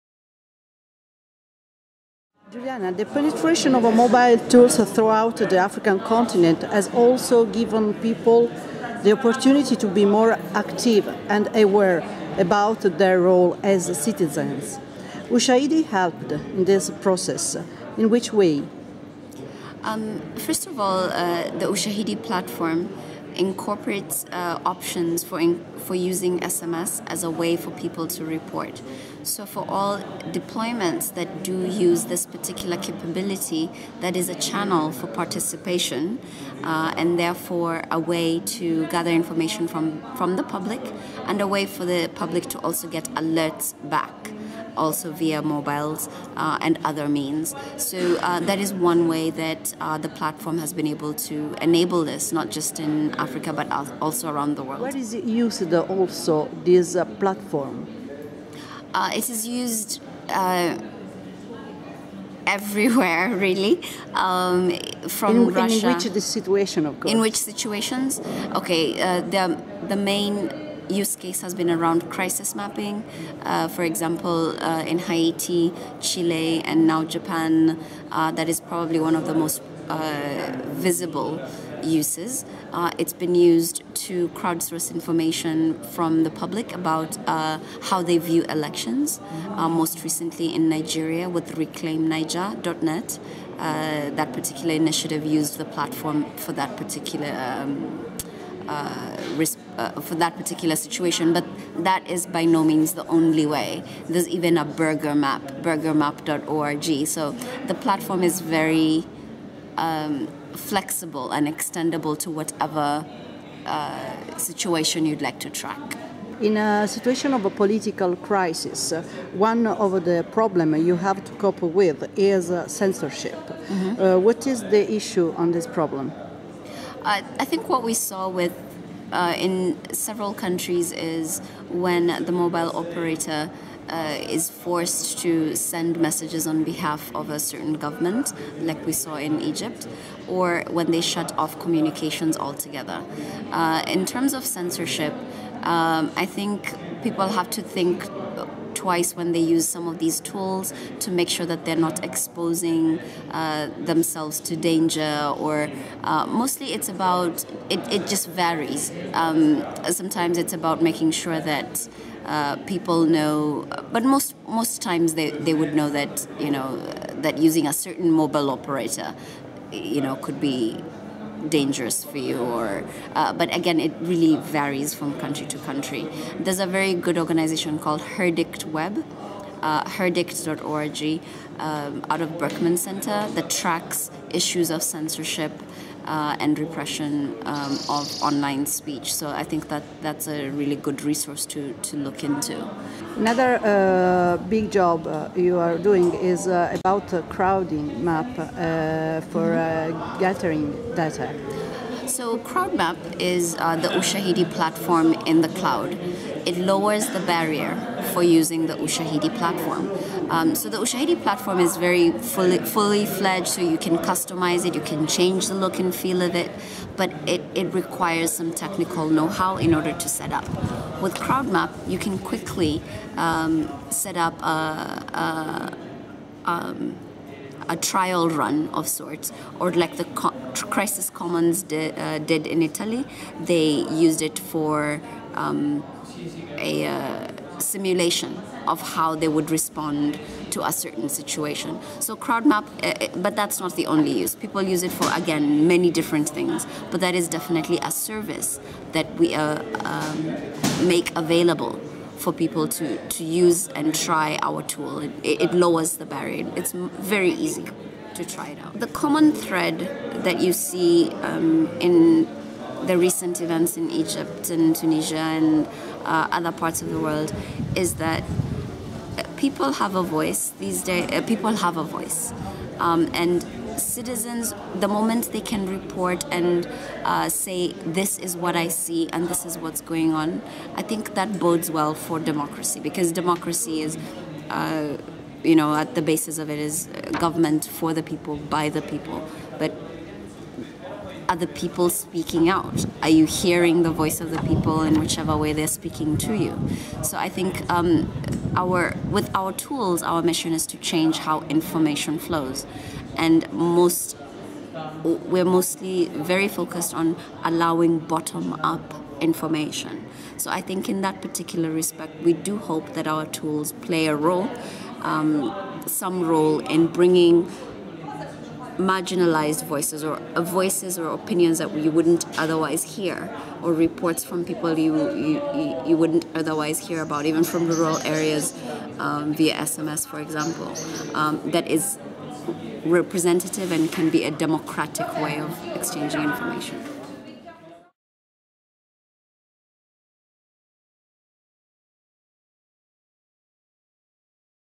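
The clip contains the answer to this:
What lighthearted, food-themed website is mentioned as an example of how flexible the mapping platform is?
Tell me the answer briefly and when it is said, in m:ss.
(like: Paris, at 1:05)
burgermap.org, at 1:45.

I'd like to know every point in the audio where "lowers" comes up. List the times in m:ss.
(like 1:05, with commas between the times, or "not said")
3:26, 4:15.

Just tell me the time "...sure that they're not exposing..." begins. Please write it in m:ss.
2:31.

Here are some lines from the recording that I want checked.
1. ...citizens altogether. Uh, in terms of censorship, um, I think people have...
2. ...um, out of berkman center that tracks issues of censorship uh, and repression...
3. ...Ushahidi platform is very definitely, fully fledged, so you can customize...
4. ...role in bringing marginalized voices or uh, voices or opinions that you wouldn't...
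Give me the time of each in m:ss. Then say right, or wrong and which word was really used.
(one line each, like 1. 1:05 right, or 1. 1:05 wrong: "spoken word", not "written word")
1. 2:21 wrong: "communications", not "citizens"
2. 3:01 right
3. 3:30 wrong: "fully", not "definitely"
4. 5:16 right.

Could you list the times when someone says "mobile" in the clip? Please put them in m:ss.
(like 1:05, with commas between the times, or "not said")
0:03, 0:45, 2:12, 2:48.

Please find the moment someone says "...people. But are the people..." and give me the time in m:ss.
4:48.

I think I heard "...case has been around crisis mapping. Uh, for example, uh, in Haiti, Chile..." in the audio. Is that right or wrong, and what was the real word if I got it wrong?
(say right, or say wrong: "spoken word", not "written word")
right.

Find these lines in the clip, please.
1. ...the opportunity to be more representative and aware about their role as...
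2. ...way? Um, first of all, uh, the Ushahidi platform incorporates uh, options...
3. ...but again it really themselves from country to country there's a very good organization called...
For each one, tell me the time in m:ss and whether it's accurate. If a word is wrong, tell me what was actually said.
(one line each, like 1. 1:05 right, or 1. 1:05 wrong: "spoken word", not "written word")
1. 0:09 wrong: "active", not "representative"
2. 0:18 right
3. 2:53 wrong: "varies", not "themselves".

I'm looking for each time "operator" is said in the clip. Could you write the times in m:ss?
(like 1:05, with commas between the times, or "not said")
2:12, 2:48.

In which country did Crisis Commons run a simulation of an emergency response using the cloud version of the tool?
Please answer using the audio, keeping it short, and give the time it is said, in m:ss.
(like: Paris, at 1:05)
Italy, at 3:52.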